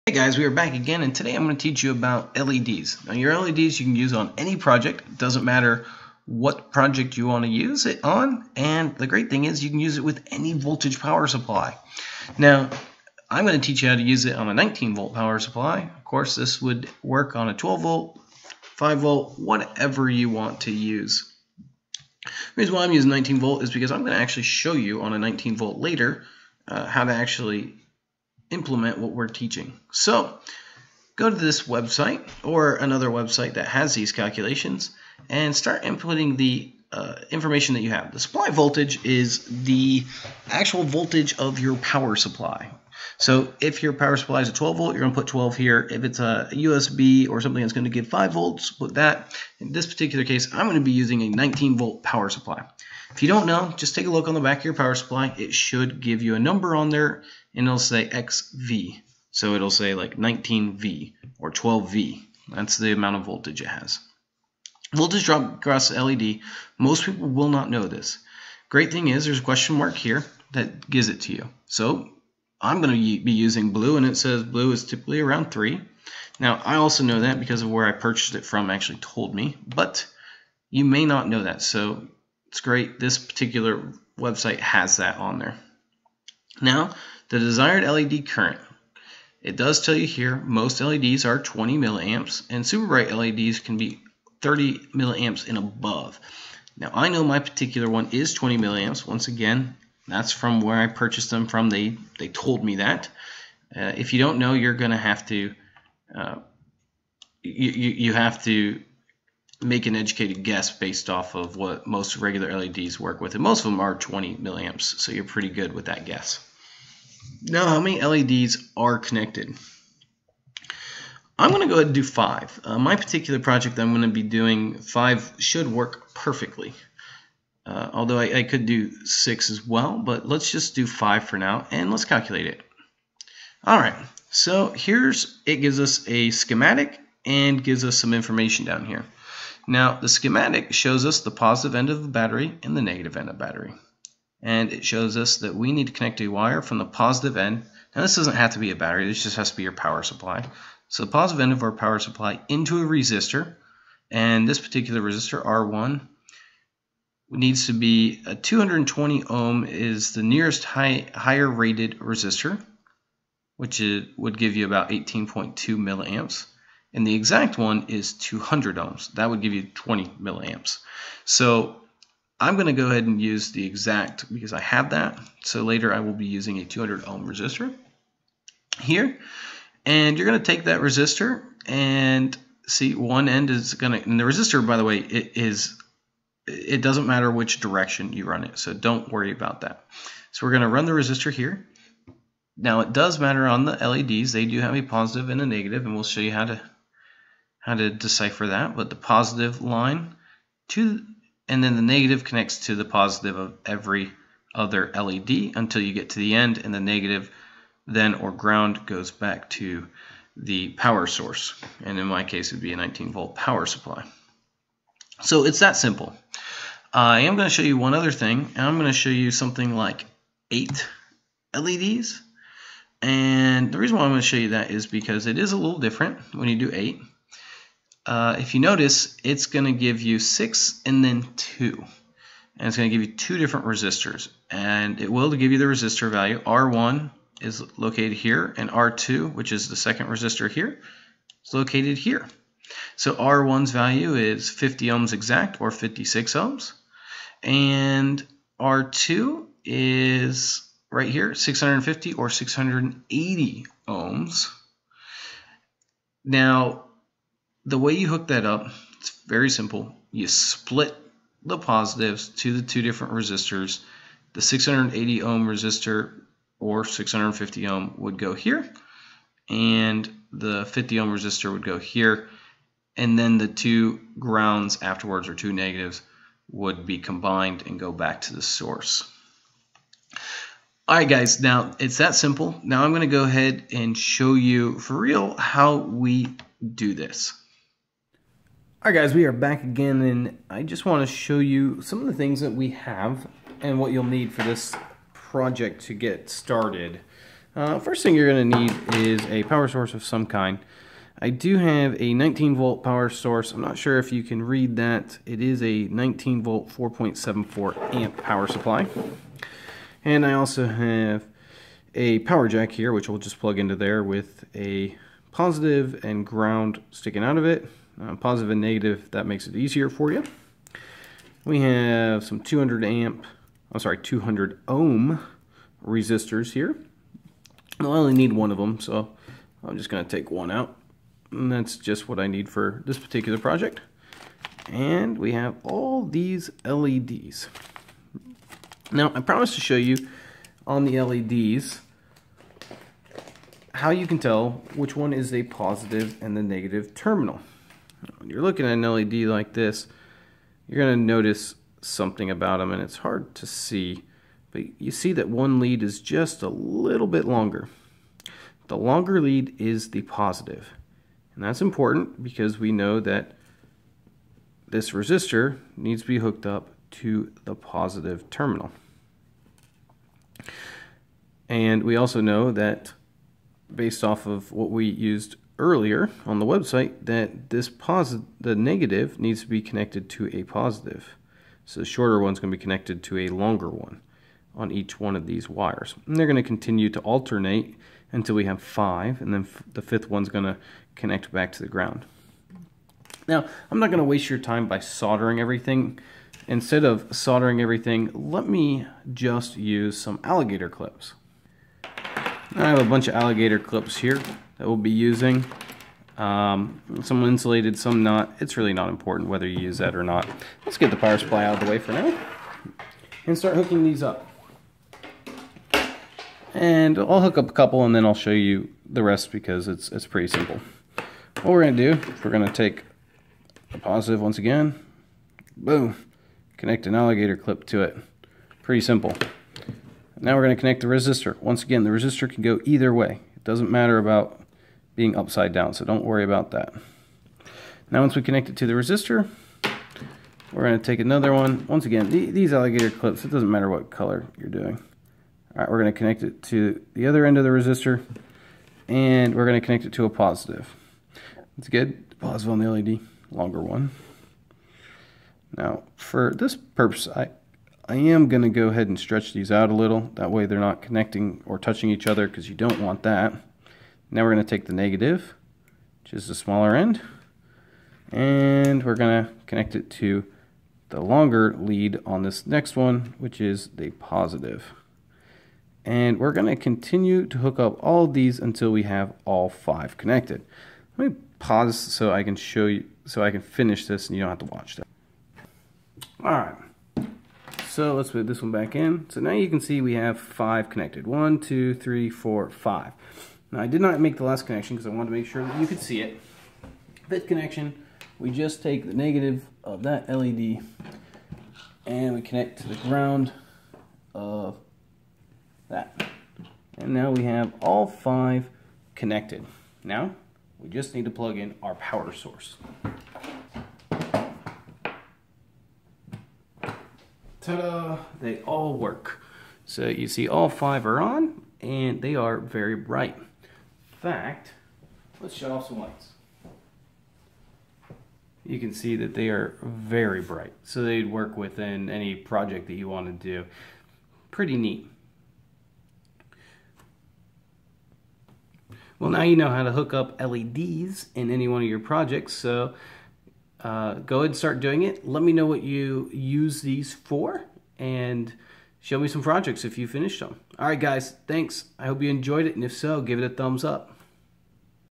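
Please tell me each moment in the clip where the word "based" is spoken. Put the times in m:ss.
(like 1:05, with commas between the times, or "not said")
1:50, 6:13.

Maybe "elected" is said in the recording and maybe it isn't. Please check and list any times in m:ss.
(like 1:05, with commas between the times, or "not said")
not said.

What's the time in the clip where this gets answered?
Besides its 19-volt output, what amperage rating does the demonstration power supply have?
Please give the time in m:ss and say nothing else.
5:06.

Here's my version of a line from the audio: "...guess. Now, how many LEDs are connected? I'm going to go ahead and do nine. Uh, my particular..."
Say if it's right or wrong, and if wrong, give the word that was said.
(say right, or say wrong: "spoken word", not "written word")
wrong: "five", not "nine".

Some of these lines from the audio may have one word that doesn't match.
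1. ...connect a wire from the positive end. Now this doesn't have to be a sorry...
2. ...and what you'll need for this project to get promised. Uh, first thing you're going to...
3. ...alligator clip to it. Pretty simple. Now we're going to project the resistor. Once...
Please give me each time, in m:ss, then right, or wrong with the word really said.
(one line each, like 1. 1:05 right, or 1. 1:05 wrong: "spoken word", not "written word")
1. 2:25 wrong: "battery", not "sorry"
2. 4:53 wrong: "started", not "promised"
3. 7:06 wrong: "connect", not "project".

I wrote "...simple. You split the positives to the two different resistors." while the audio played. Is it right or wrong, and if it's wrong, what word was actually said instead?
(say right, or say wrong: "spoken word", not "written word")
right.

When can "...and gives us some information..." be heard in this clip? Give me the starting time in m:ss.
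2:17.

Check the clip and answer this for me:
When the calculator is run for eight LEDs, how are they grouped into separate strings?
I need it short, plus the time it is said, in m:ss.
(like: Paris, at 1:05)
6 and 2, at 3:50.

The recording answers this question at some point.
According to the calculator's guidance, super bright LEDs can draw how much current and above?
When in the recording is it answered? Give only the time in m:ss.
1:34.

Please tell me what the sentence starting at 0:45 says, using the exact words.
If it's a USB or something that's going to give 5 volts, put that.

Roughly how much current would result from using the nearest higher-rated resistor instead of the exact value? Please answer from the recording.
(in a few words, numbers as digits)
18.2 milliamps.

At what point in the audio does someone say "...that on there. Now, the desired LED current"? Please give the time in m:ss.
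1:24.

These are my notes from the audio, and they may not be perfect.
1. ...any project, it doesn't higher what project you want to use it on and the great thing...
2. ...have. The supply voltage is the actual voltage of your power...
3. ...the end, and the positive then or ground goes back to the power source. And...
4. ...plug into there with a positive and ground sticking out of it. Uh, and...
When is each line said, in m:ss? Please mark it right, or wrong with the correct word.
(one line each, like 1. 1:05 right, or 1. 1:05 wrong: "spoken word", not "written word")
1. 0:04 wrong: "matter", not "higher"
2. 0:37 right
3. 3:26 wrong: "negative", not "positive"
4. 5:13 right.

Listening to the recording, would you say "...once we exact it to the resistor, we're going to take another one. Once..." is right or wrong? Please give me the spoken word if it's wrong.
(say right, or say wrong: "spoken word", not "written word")
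wrong: "connect", not "exact".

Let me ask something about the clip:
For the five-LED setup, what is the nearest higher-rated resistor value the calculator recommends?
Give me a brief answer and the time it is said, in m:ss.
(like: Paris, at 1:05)
220 ohm, at 2:38.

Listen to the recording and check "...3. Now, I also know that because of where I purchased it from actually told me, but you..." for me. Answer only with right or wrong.
right.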